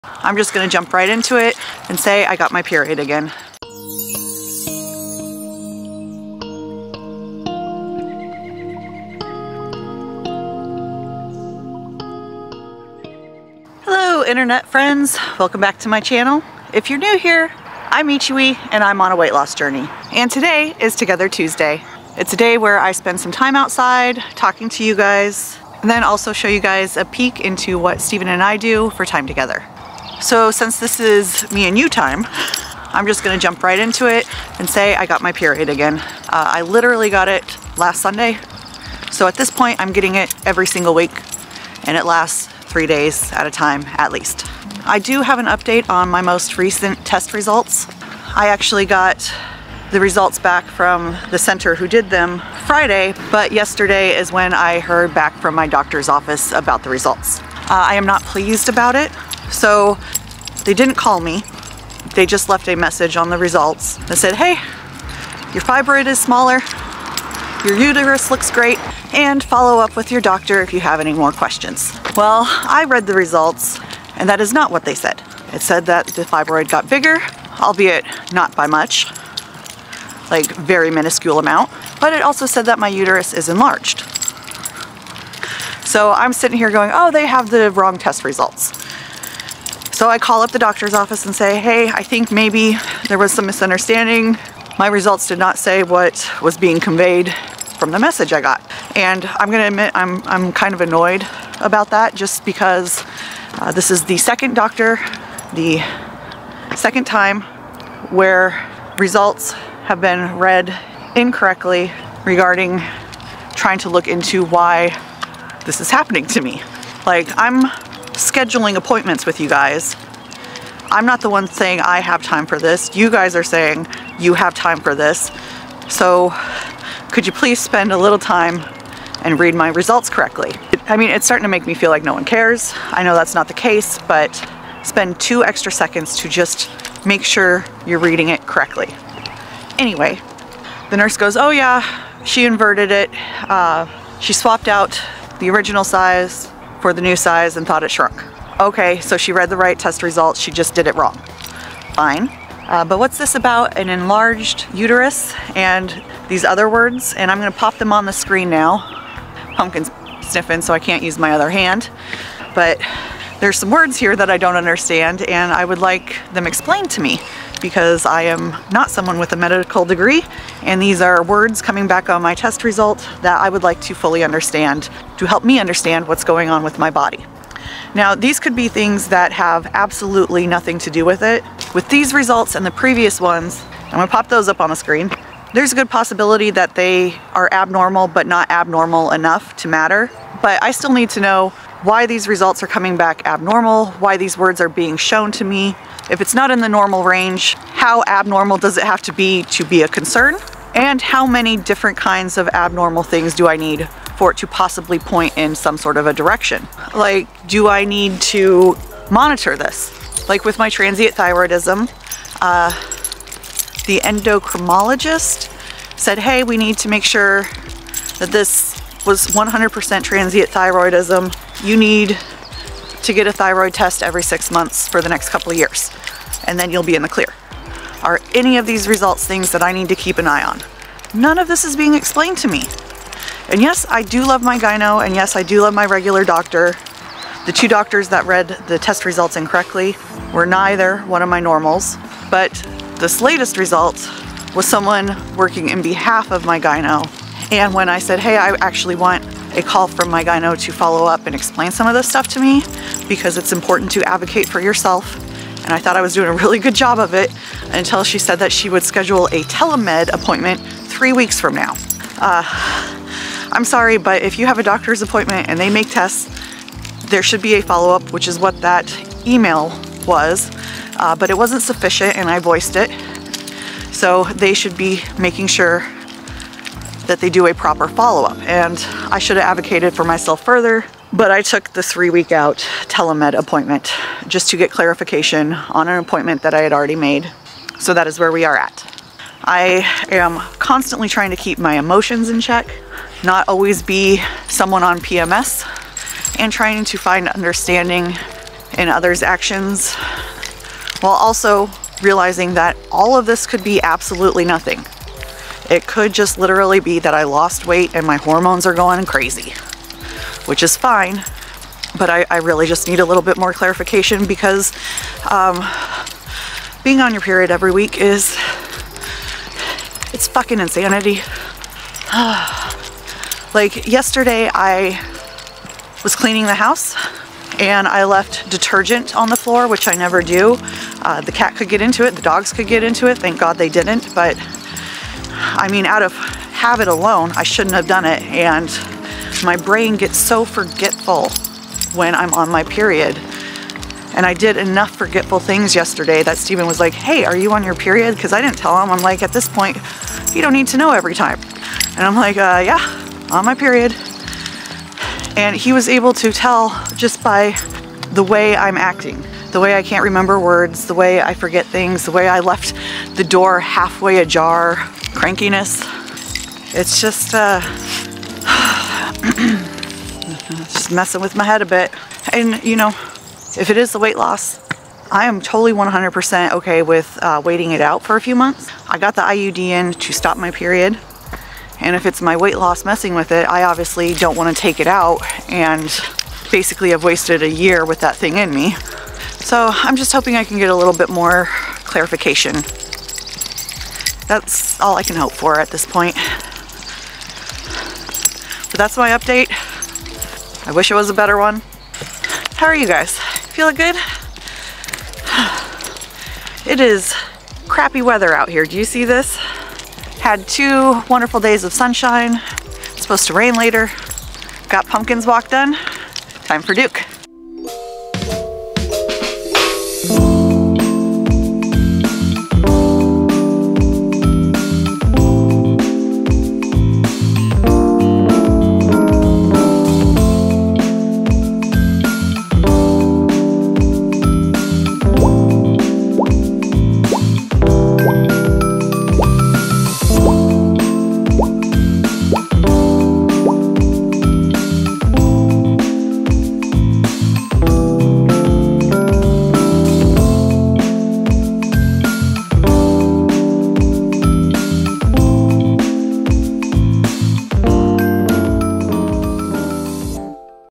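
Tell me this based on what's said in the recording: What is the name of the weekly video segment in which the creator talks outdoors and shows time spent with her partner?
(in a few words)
Together Tuesday.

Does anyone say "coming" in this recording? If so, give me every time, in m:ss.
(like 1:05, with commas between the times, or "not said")
2:51, 3:12.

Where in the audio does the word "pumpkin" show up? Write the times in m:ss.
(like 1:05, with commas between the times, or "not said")
2:39, 6:54.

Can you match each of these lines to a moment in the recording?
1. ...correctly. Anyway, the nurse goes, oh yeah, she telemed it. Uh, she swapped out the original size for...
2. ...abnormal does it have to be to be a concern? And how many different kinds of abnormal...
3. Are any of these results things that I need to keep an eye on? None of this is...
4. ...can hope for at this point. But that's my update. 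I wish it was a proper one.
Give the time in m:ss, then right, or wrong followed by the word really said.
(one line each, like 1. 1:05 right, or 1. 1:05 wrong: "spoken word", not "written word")
1. 2:18 wrong: "inverted", not "telemed"
2. 3:18 right
3. 3:48 right
4. 6:35 wrong: "better", not "proper".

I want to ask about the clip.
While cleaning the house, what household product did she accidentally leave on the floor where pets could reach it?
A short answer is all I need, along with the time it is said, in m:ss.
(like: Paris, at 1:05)
detergent, at 5:28.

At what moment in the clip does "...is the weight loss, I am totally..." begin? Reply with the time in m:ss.
6:13.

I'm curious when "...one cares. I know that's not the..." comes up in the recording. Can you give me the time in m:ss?
2:12.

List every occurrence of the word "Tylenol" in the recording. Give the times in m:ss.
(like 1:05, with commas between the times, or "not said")
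not said.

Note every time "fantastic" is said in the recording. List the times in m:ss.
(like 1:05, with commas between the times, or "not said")
not said.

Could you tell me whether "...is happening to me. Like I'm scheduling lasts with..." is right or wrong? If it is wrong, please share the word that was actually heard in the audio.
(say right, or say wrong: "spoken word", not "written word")
wrong: "appointments", not "lasts".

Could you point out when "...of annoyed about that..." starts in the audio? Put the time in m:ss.
1:40.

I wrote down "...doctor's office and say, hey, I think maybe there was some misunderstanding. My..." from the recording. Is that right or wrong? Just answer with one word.
right.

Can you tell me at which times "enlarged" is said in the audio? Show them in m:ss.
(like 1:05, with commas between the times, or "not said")
1:23, 2:33.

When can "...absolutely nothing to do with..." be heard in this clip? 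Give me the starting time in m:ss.
2:59.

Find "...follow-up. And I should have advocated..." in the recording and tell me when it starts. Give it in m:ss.
4:37.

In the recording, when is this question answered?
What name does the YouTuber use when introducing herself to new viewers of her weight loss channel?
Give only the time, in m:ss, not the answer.
0:18.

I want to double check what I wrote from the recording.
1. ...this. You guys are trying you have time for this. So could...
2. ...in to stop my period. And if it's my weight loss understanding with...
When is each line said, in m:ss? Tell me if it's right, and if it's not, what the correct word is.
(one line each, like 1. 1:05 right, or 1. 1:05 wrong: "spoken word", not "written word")
1. 2:02 wrong: "saying", not "trying"
2. 6:19 wrong: "messing", not "understanding".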